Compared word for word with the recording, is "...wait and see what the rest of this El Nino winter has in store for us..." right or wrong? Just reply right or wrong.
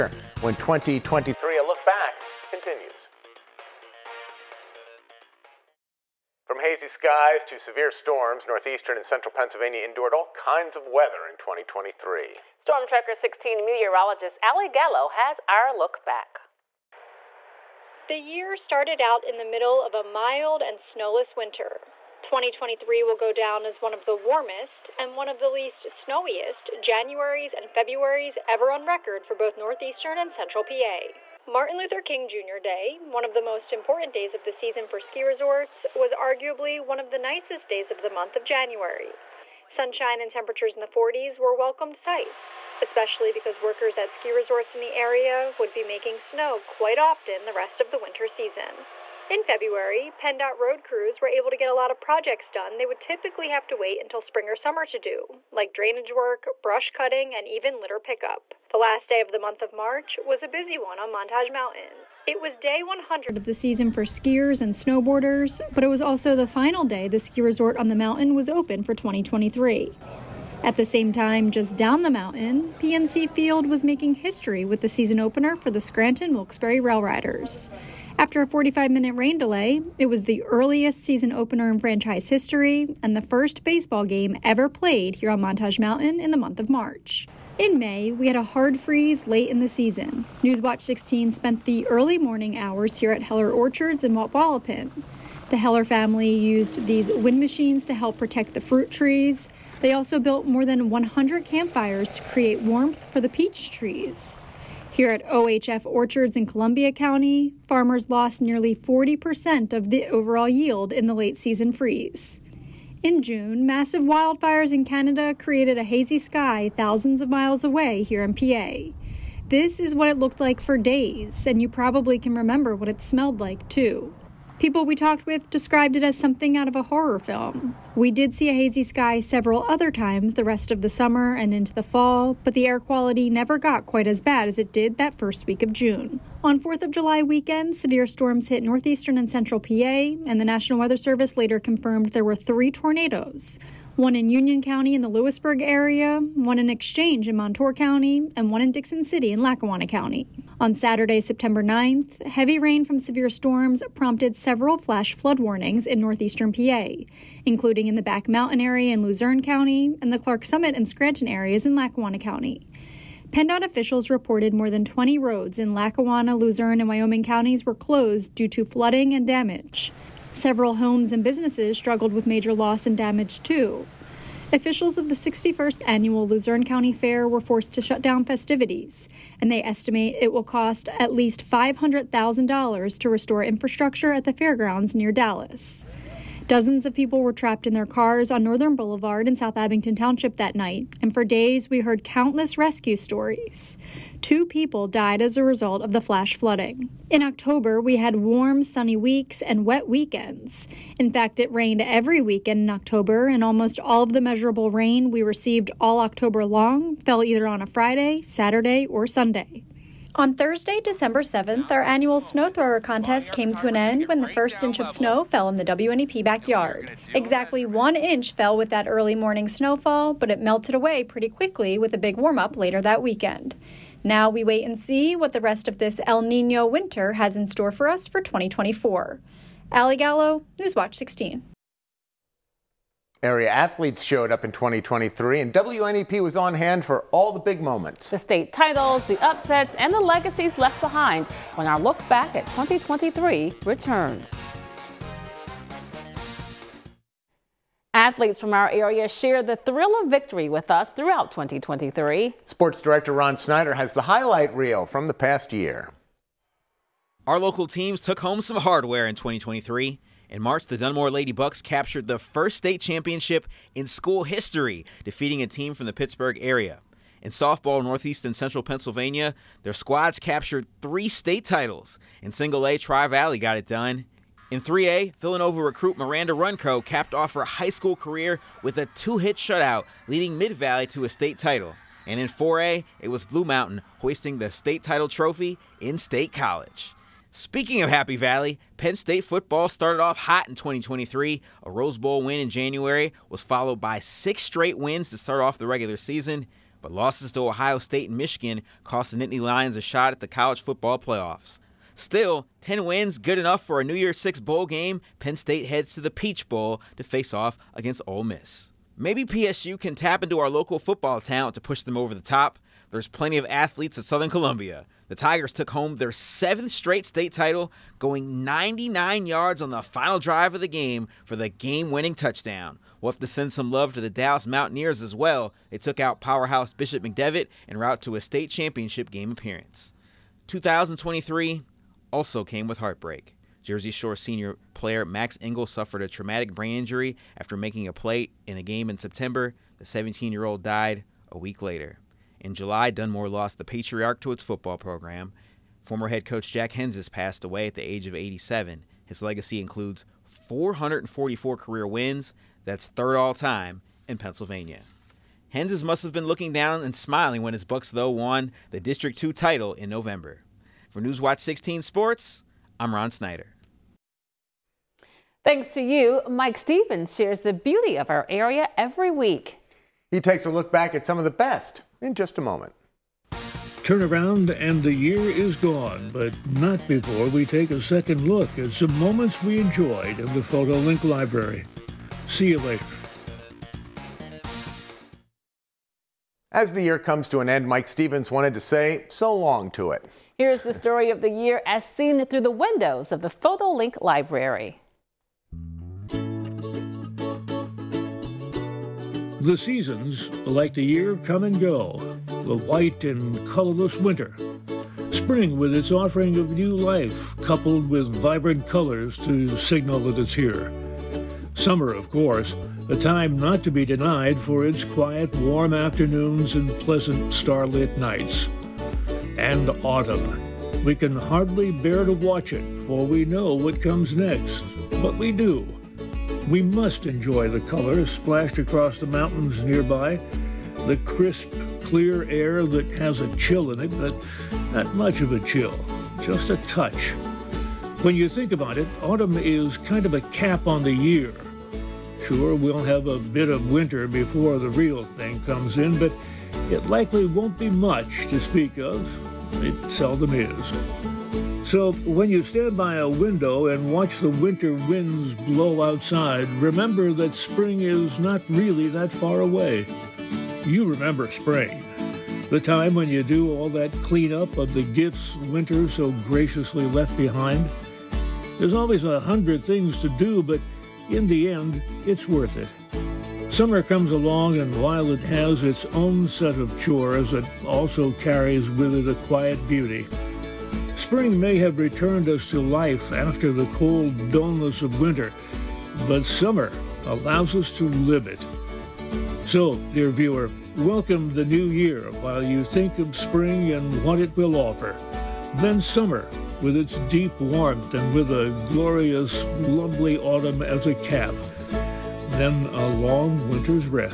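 right.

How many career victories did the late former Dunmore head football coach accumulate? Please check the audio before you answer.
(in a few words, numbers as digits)
444.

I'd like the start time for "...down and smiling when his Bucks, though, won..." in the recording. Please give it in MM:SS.
05:56.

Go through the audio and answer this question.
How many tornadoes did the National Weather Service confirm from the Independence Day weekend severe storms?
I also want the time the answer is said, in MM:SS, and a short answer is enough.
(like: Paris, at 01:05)
3, at 02:22.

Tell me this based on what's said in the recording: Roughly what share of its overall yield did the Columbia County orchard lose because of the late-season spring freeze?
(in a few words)
40%.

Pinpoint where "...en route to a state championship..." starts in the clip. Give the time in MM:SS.
05:27.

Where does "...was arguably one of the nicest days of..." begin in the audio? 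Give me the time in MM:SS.
00:35.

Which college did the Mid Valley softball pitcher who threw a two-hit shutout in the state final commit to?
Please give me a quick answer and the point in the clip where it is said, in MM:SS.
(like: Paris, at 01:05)
Villanova, at 04:35.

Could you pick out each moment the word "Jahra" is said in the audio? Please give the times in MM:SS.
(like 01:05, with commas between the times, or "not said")
not said.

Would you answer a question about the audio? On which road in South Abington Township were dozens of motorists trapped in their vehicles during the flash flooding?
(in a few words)
Northern Boulevard.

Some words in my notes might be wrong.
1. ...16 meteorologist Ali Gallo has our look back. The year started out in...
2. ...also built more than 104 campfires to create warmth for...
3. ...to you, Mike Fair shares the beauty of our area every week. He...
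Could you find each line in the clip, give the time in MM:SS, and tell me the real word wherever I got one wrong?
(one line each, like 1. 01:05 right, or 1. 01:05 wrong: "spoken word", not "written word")
1. 00:13 right
2. 01:39 wrong: "100", not "104"
3. 06:05 wrong: "Stevens", not "Fair".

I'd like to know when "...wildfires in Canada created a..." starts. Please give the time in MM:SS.
01:54.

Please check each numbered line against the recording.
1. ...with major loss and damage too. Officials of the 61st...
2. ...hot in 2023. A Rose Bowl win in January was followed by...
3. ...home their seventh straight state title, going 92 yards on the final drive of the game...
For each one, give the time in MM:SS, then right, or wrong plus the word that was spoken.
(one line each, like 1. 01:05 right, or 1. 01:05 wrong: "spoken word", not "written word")
1. 02:52 right
2. 04:50 right
3. 05:15 wrong: "99", not "92".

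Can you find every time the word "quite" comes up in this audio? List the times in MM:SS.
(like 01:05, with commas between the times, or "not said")
00:46, 02:13.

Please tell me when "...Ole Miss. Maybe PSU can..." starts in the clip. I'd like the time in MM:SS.
05:08.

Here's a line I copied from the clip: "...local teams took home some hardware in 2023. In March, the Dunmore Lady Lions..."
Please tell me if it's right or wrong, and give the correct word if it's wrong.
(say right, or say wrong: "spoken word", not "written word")
wrong: "Bucks", not "Lions".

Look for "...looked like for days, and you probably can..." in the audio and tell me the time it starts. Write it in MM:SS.
02:00.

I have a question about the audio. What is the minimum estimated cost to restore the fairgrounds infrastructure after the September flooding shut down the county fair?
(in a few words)
$500,000.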